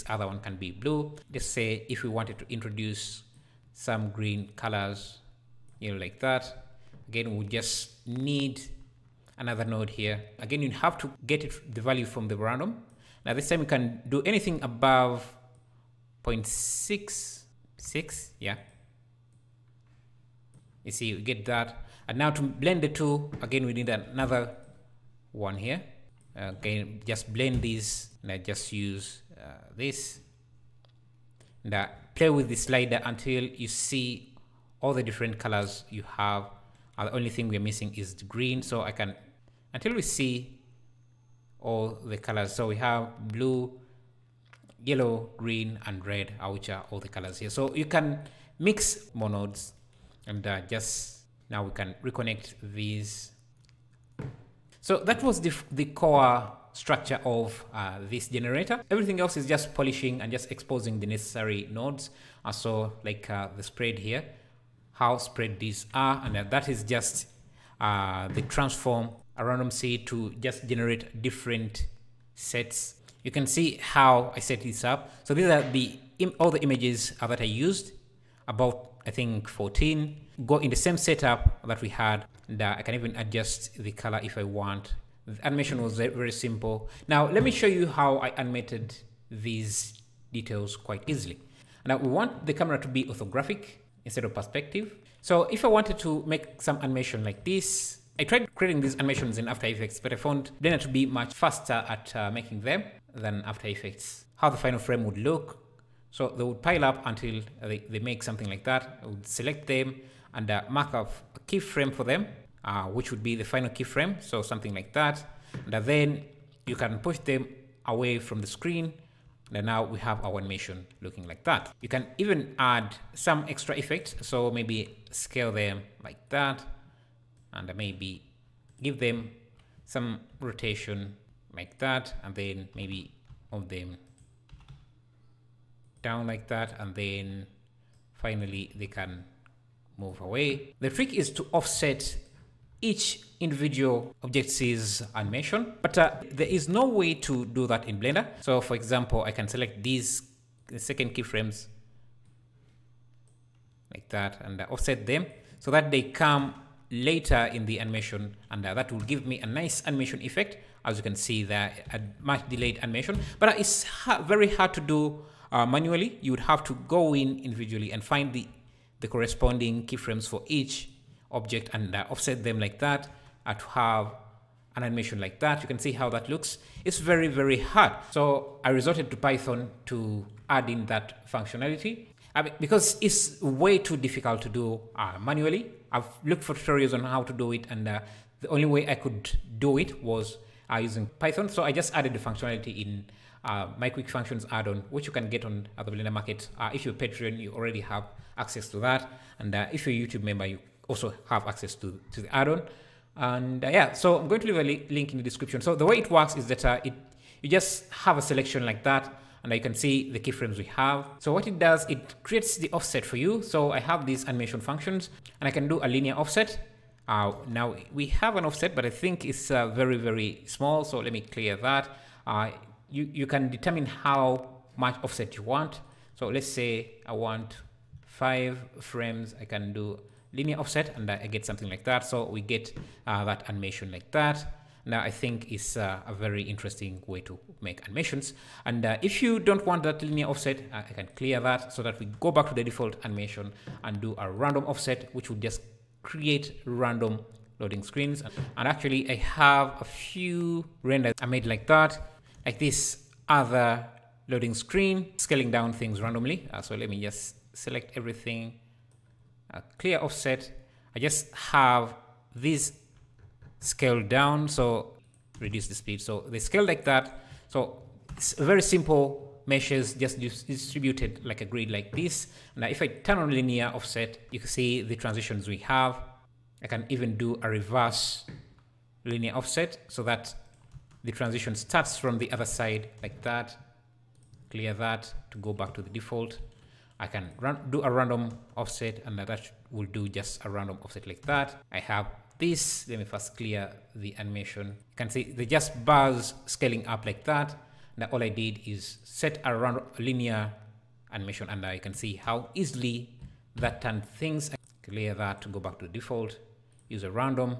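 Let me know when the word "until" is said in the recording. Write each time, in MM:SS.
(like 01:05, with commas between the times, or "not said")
00:33, 00:39, 01:47.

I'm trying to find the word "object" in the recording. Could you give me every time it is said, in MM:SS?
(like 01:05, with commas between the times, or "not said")
02:24, 02:51.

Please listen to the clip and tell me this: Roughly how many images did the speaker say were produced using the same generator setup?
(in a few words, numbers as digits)
14.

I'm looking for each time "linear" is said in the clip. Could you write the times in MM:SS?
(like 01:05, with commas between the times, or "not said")
03:35, 03:50, 04:00, 04:33, 04:39, 04:59.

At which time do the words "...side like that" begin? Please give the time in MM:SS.
04:42.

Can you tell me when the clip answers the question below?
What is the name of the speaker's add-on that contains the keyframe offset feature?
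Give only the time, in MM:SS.
03:13.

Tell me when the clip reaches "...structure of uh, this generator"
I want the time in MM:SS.
00:56.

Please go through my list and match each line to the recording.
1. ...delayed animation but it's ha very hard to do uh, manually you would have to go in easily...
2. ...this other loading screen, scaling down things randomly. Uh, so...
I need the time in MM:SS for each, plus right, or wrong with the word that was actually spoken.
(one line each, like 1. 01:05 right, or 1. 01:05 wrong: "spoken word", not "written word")
1. 02:42 wrong: "individually", not "easily"
2. 04:12 right.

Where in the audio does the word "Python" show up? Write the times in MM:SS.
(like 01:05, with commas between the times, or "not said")
02:59, 03:11.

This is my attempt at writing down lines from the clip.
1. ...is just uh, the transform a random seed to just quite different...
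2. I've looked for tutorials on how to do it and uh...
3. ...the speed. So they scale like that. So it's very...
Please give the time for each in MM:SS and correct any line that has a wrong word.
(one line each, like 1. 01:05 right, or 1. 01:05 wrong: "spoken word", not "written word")
1. 01:06 wrong: "generate", not "quite"
2. 03:05 right
3. 04:25 right.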